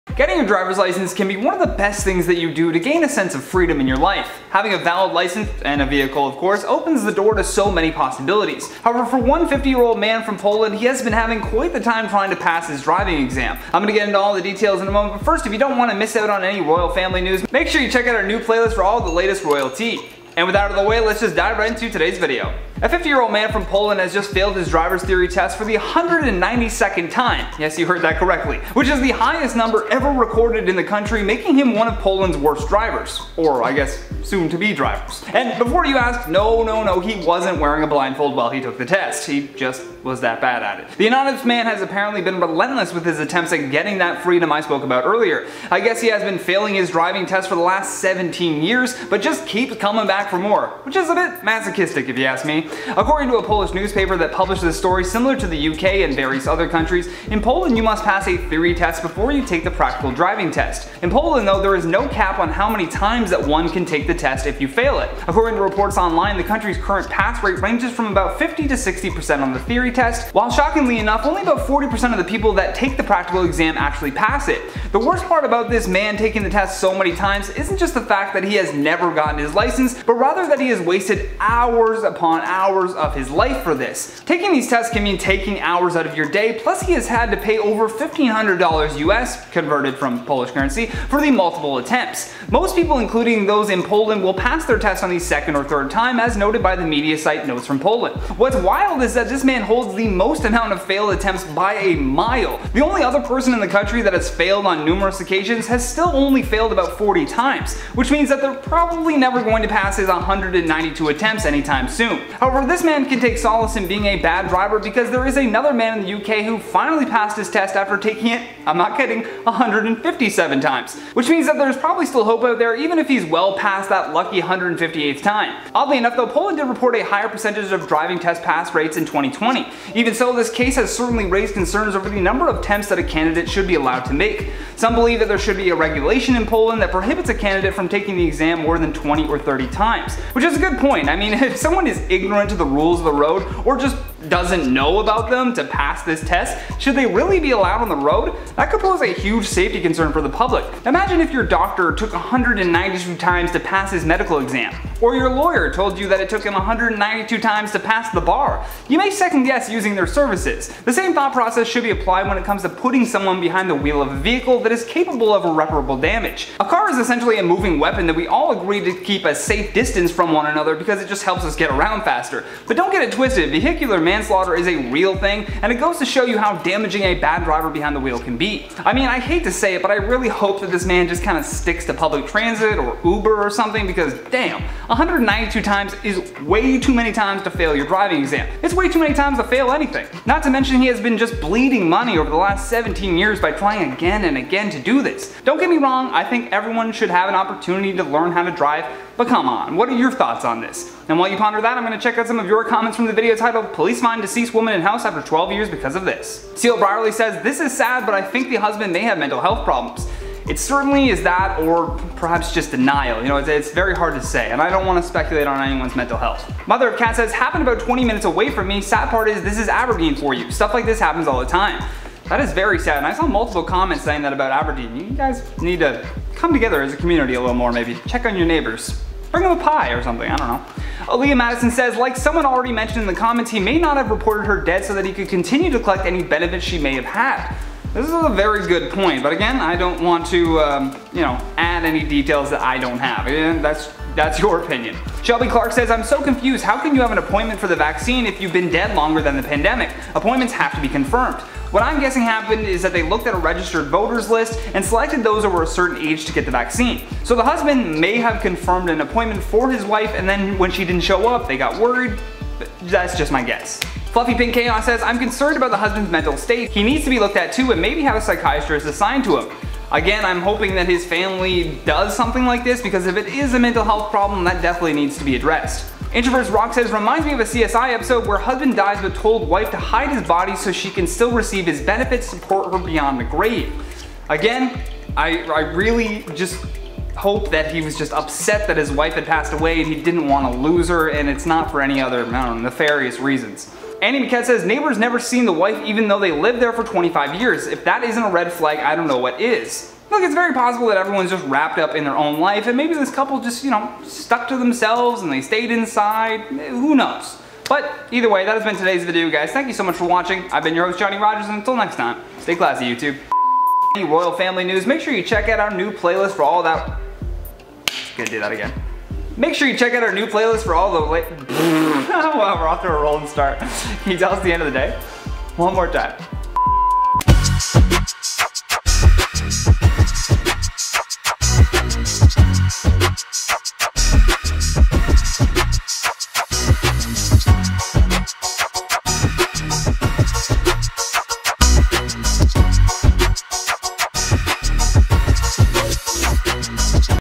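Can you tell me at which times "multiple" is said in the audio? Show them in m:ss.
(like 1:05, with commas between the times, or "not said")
1:31, 3:43.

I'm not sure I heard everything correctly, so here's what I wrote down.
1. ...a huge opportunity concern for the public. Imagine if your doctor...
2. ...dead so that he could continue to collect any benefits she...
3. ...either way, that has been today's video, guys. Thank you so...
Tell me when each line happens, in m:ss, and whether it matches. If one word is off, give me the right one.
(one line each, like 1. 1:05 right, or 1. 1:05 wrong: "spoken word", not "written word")
1. 2:29 wrong: "safety", not "opportunity"
2. 3:54 right
3. 5:08 right.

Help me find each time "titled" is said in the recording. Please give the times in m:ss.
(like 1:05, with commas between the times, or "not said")
3:23.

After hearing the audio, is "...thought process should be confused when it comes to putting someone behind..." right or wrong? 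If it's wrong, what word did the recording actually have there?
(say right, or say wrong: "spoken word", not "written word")
wrong: "applied", not "confused".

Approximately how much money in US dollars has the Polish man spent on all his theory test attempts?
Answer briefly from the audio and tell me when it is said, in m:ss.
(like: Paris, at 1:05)
$1,500, at 1:27.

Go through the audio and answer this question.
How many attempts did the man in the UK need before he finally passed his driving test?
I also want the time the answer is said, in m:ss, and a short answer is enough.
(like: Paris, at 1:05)
157, at 1:59.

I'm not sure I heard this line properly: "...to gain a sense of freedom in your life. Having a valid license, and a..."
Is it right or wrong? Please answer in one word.
right.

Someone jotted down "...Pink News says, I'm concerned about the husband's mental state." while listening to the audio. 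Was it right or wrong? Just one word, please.
wrong.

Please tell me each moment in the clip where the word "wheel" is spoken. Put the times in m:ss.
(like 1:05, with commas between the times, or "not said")
2:43, 2:57.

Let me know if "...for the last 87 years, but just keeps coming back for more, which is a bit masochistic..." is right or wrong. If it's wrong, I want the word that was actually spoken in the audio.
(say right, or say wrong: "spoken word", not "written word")
wrong: "17", not "87".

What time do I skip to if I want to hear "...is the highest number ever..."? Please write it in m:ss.
0:28.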